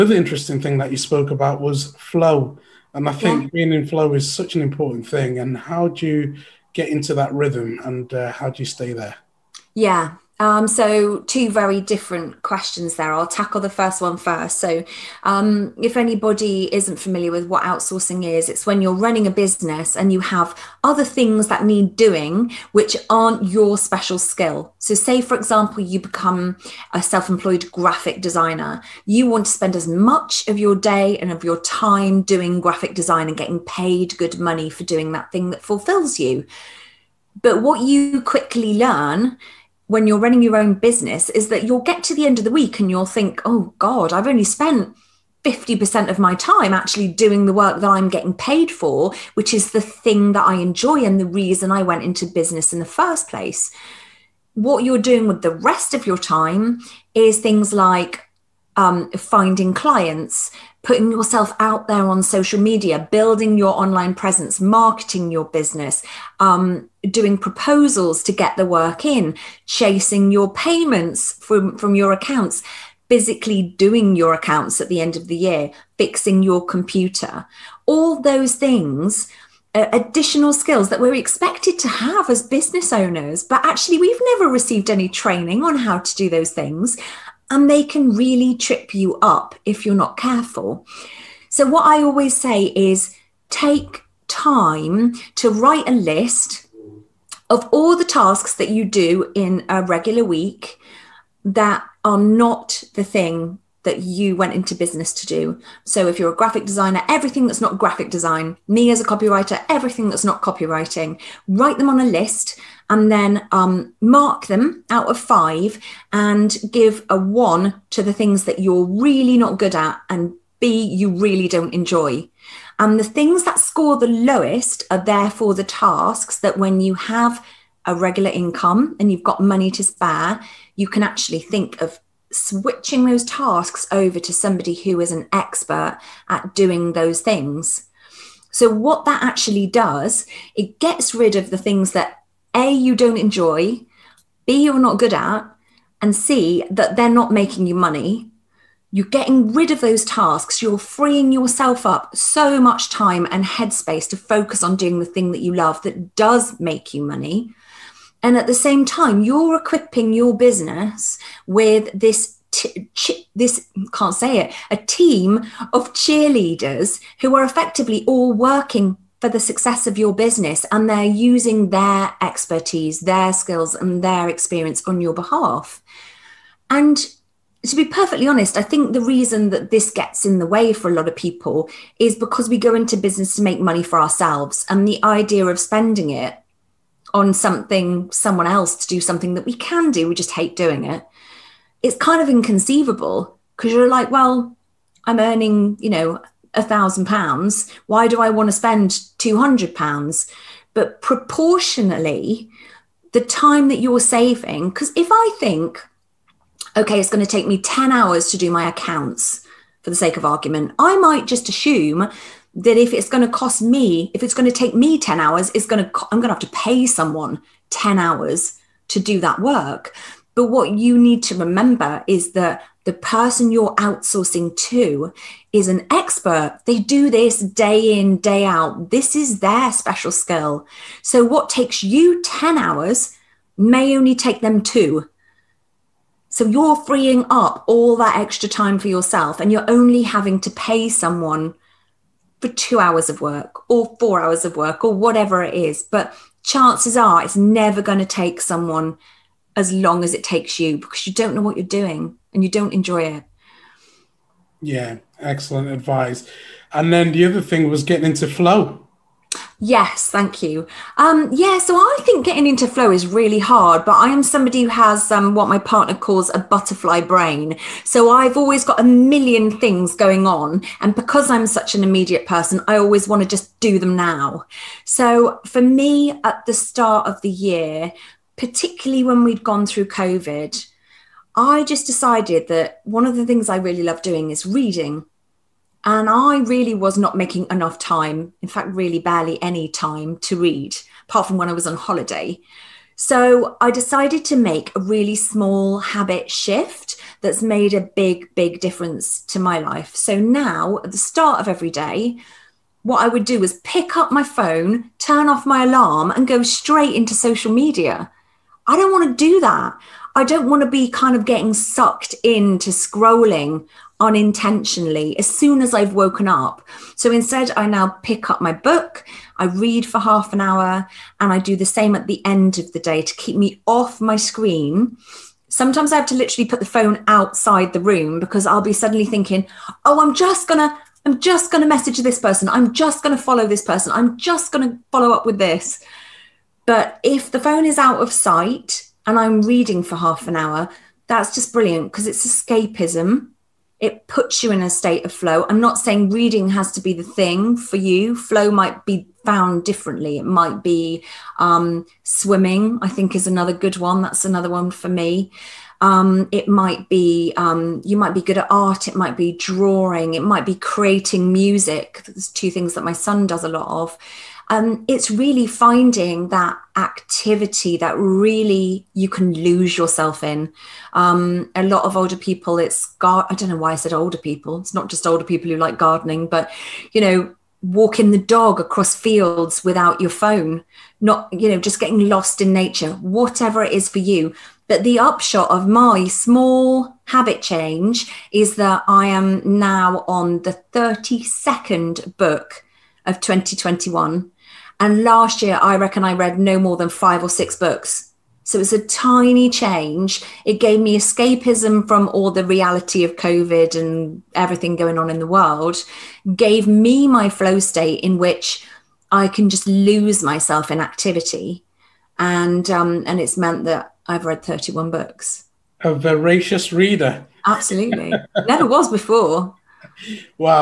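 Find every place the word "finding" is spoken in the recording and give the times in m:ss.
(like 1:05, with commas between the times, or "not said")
0:59, 6:05.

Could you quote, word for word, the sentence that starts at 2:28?
You're getting rid of those tasks.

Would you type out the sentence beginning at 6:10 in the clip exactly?
Um, a lot of older people, it's gar- I don't know why I said older people.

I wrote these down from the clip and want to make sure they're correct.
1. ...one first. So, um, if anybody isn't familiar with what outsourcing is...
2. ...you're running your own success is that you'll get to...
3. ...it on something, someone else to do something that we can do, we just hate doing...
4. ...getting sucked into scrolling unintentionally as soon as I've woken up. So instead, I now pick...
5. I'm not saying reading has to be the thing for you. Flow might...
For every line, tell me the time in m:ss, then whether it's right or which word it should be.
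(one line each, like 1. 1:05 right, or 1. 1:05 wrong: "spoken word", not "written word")
1. 0:13 right
2. 0:40 wrong: "business", not "success"
3. 3:06 right
4. 5:11 right
5. 5:45 right.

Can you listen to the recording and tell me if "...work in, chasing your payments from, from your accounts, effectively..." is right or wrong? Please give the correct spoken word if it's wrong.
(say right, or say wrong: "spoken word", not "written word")
wrong: "physically", not "effectively".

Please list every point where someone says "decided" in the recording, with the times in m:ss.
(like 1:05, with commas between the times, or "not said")
4:41, 4:53.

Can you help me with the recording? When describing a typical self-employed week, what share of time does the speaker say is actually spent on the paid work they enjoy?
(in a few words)
50%.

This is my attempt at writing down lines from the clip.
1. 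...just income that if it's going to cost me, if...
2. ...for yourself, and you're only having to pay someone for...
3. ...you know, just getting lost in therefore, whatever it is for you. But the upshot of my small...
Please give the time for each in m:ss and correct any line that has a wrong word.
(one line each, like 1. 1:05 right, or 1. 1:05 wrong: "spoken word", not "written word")
1. 3:31 wrong: "assume", not "income"
2. 3:58 right
3. 6:21 wrong: "nature", not "therefore".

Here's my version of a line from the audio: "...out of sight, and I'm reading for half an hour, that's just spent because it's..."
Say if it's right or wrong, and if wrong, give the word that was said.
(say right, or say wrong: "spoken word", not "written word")
wrong: "brilliant", not "spent".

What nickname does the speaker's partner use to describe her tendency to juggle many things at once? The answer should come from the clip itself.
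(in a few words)
butterfly brain.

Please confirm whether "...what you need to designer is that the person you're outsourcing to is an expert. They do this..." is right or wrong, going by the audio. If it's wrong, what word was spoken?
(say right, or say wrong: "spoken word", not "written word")
wrong: "remember", not "designer".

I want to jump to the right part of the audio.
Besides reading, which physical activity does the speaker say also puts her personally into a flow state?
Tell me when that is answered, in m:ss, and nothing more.
5:52.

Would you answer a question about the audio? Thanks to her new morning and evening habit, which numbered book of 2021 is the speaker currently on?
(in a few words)
32nd.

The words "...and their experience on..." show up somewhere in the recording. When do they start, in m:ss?
2:53.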